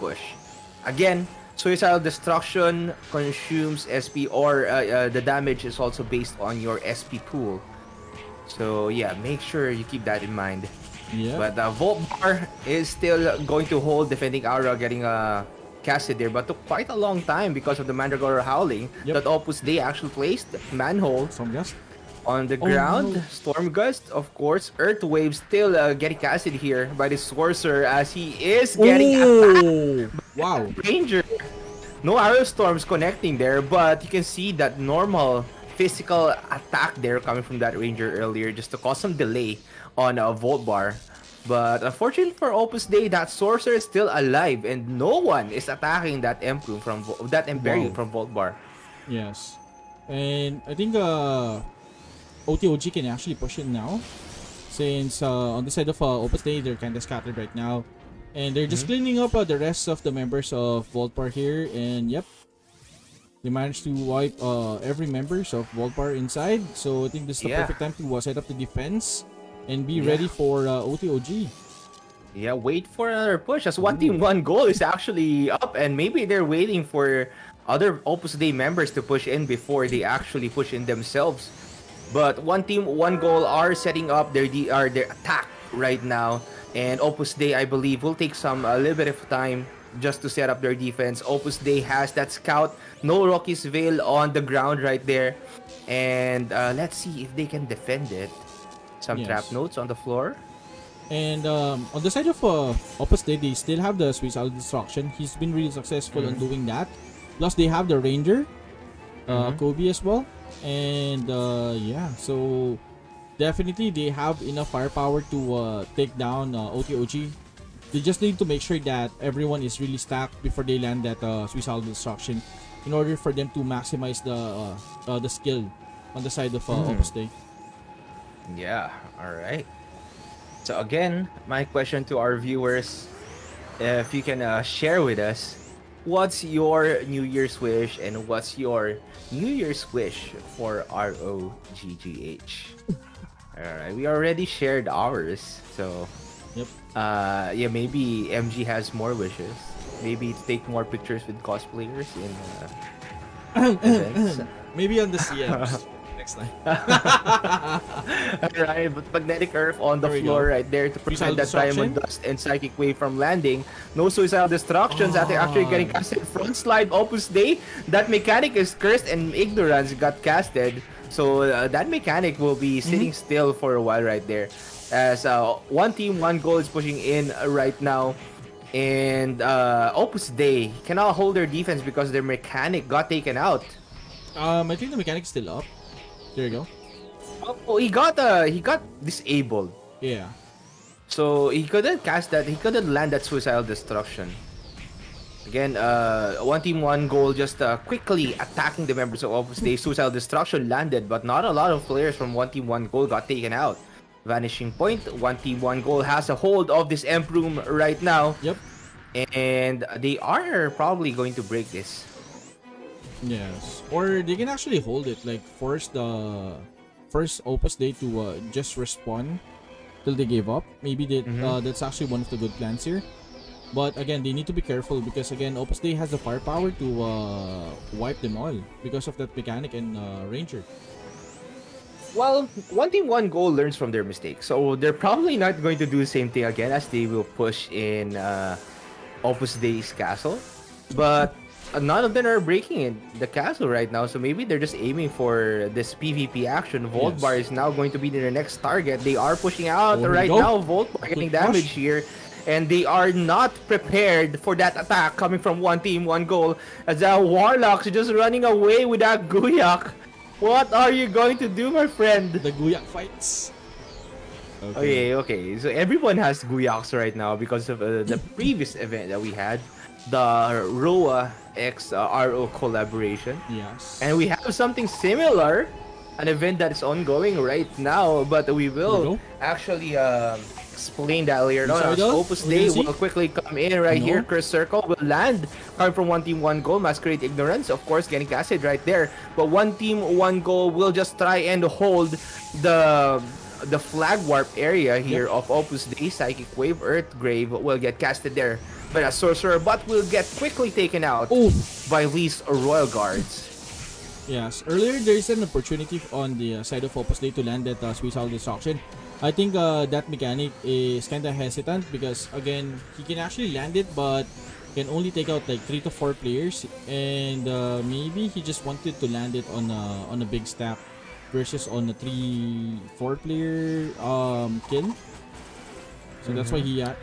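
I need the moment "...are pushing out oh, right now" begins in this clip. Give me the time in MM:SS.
04:09.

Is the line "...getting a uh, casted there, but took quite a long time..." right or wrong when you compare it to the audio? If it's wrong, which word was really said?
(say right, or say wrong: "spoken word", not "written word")
right.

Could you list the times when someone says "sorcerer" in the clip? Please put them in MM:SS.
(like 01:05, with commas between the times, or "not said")
00:27, 00:43, 04:59.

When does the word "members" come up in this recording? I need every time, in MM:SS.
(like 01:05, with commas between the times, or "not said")
01:00, 01:05, 01:18, 03:18.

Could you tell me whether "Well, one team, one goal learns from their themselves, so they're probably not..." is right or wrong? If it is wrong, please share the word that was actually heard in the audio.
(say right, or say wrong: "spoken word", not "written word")
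wrong: "mistakes", not "themselves".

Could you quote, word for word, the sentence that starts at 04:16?
As the Warlocks just running away with that Guyak.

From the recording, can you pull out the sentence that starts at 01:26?
And Opus Dei I believe, will take some a uh, little bit of time just to set up their defense.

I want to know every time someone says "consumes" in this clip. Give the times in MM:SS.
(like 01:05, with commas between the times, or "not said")
00:03.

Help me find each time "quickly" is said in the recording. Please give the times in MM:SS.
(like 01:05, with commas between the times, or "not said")
03:17, 04:42, 05:00.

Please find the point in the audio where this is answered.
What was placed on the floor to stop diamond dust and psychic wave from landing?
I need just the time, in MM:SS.
02:39.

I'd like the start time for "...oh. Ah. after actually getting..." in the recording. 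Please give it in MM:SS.
02:45.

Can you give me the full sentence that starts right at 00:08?
So yeah, make sure you keep that in mind.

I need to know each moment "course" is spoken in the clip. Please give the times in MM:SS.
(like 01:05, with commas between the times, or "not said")
00:24, 04:47.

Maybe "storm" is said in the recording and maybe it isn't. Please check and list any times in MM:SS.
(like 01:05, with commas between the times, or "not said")
00:23, 00:32.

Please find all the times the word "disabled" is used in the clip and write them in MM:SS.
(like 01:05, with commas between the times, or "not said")
03:09.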